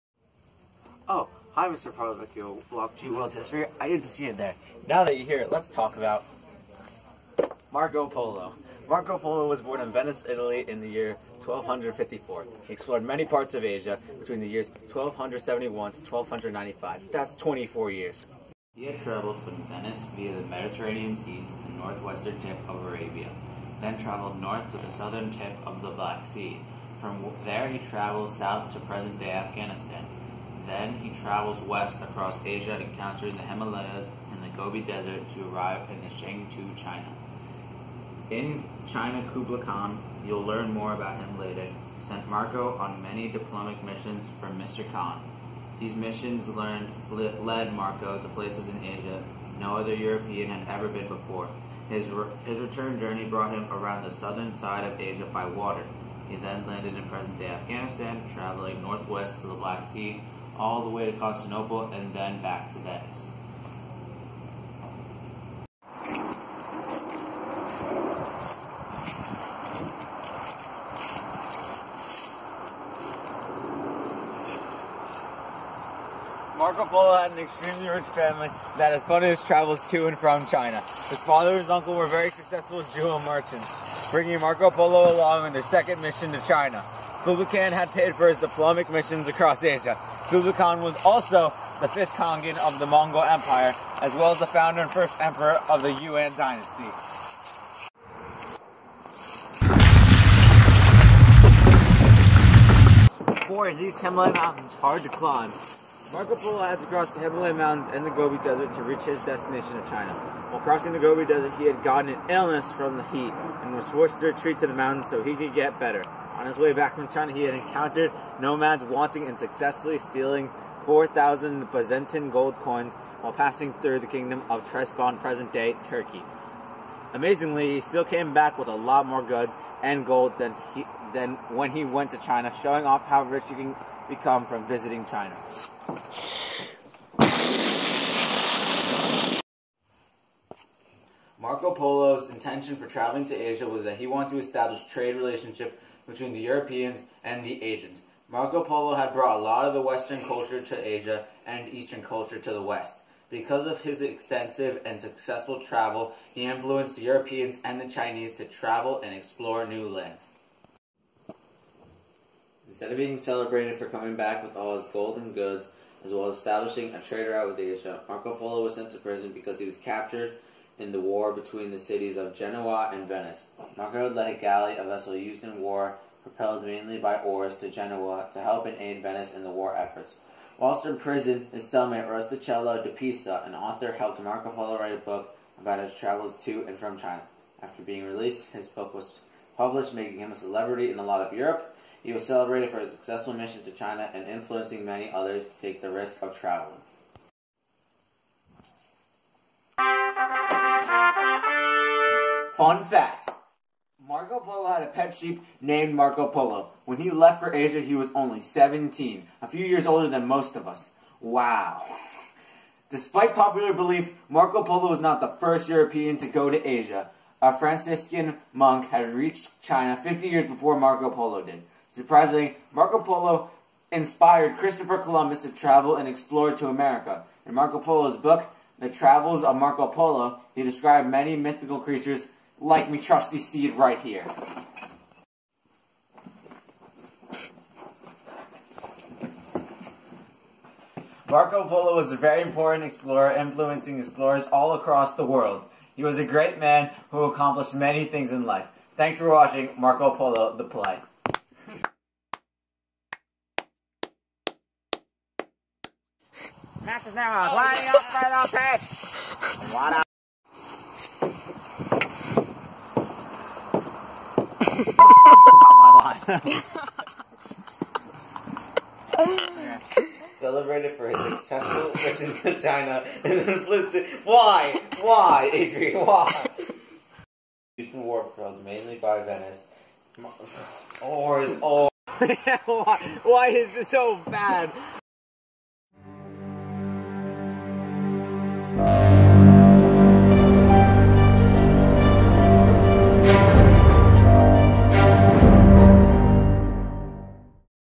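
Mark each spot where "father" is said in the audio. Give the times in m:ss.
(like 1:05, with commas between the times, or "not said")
1:21.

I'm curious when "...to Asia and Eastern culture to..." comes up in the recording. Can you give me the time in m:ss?
2:30.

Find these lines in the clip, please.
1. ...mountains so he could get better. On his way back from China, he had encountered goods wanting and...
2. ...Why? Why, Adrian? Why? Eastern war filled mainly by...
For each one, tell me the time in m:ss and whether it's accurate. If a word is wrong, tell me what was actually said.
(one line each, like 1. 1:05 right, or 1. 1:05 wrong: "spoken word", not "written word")
1. 1:54 wrong: "nomads", not "goods"
2. 4:34 right.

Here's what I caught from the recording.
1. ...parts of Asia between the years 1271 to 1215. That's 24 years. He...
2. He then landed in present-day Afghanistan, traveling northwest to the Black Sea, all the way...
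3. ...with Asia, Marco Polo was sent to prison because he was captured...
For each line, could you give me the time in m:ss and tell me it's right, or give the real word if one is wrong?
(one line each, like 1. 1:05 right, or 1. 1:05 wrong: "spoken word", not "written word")
1. 0:13 wrong: "1295", not "1215"
2. 0:56 right
3. 2:47 right.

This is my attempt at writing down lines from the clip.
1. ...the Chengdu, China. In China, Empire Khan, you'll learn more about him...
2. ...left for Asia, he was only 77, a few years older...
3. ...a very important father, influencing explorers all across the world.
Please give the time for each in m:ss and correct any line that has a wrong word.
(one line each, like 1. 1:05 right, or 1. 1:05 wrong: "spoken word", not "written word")
1. 0:36 wrong: "Kublai", not "Empire"
2. 3:27 wrong: "17", not "77"
3. 4:02 wrong: "explorer", not "father".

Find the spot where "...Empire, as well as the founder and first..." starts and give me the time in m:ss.
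1:33.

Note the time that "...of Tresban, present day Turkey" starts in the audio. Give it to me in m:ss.
2:04.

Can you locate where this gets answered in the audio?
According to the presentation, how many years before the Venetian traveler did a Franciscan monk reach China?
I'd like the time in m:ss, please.
3:40.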